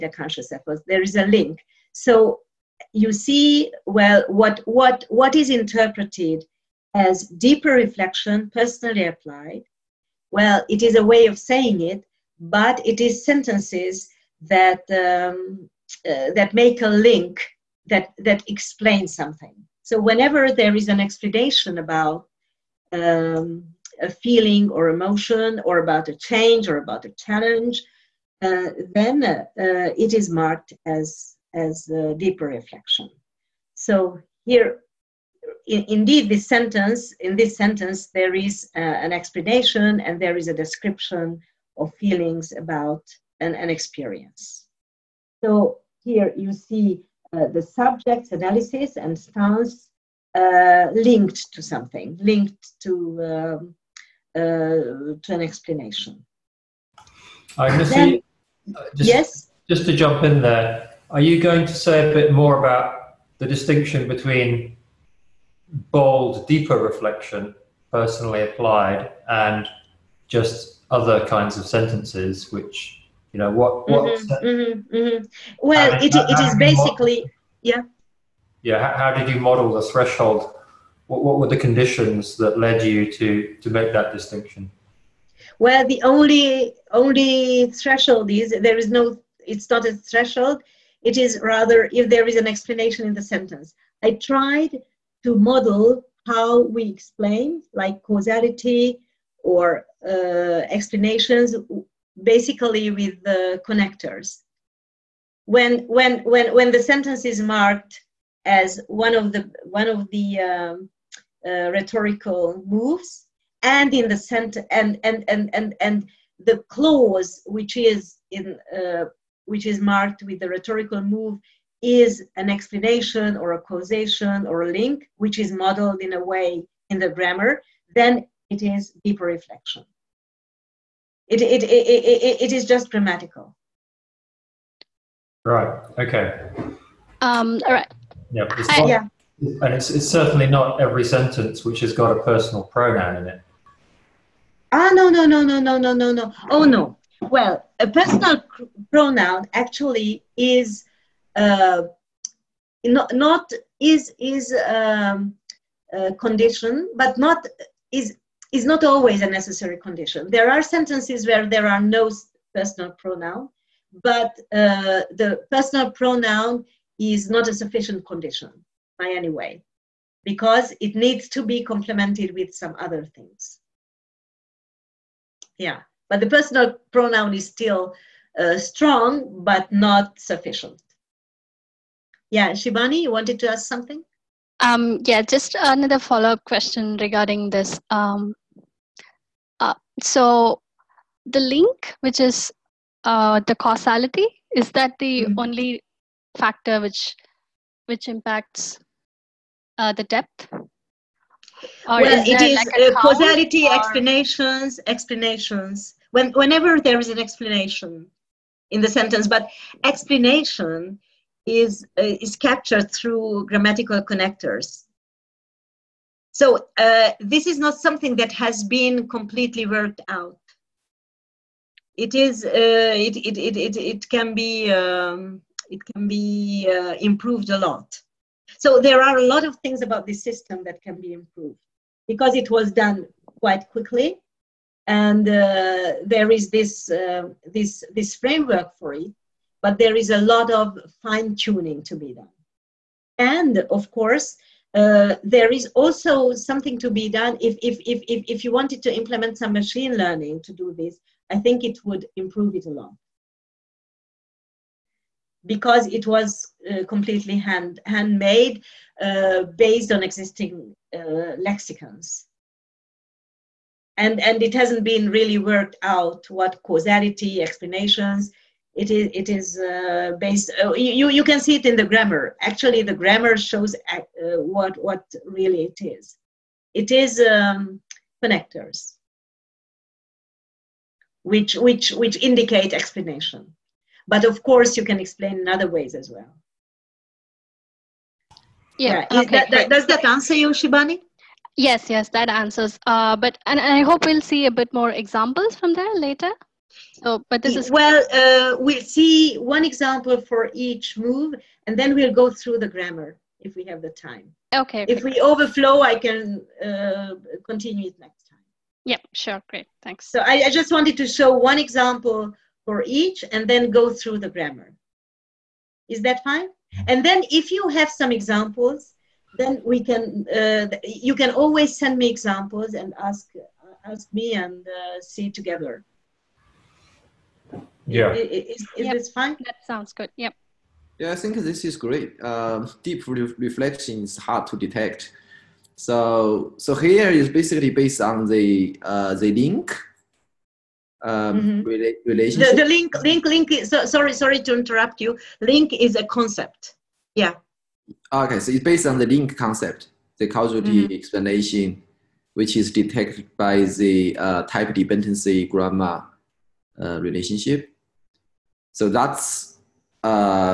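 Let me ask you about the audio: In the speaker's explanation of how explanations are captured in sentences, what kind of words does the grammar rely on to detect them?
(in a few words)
grammatical connectors.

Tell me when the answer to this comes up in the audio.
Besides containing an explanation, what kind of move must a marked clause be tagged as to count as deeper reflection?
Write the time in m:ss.
1:51.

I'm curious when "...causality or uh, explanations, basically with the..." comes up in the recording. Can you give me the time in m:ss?
1:38.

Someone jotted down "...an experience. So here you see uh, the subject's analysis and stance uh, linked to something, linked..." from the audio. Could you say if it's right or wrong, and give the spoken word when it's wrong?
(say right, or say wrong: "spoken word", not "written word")
right.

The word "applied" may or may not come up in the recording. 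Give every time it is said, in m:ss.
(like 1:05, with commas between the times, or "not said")
0:09, 1:08.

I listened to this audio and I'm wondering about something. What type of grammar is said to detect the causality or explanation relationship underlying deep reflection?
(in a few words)
type dependency grammar.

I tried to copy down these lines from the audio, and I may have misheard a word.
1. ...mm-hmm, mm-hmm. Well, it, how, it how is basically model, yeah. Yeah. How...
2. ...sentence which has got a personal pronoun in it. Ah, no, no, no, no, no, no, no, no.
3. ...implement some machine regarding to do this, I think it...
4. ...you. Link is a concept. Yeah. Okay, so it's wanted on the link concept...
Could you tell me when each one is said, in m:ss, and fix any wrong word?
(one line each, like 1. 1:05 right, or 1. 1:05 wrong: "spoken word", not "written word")
1. 1:14 right
2. 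2:21 right
3. 4:08 wrong: "learning", not "regarding"
4. 5:45 wrong: "based", not "wanted".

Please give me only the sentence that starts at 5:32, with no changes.
Uh, deep re- reflection is hard to detect.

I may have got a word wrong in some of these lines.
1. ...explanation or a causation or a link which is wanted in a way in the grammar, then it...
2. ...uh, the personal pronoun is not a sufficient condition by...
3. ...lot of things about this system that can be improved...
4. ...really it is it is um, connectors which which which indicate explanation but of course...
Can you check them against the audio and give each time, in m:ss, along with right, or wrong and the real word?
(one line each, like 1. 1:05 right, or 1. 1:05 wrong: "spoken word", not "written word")
1. 2:02 wrong: "modeled", not "wanted"
2. 2:44 right
3. 3:49 right
4. 4:35 right.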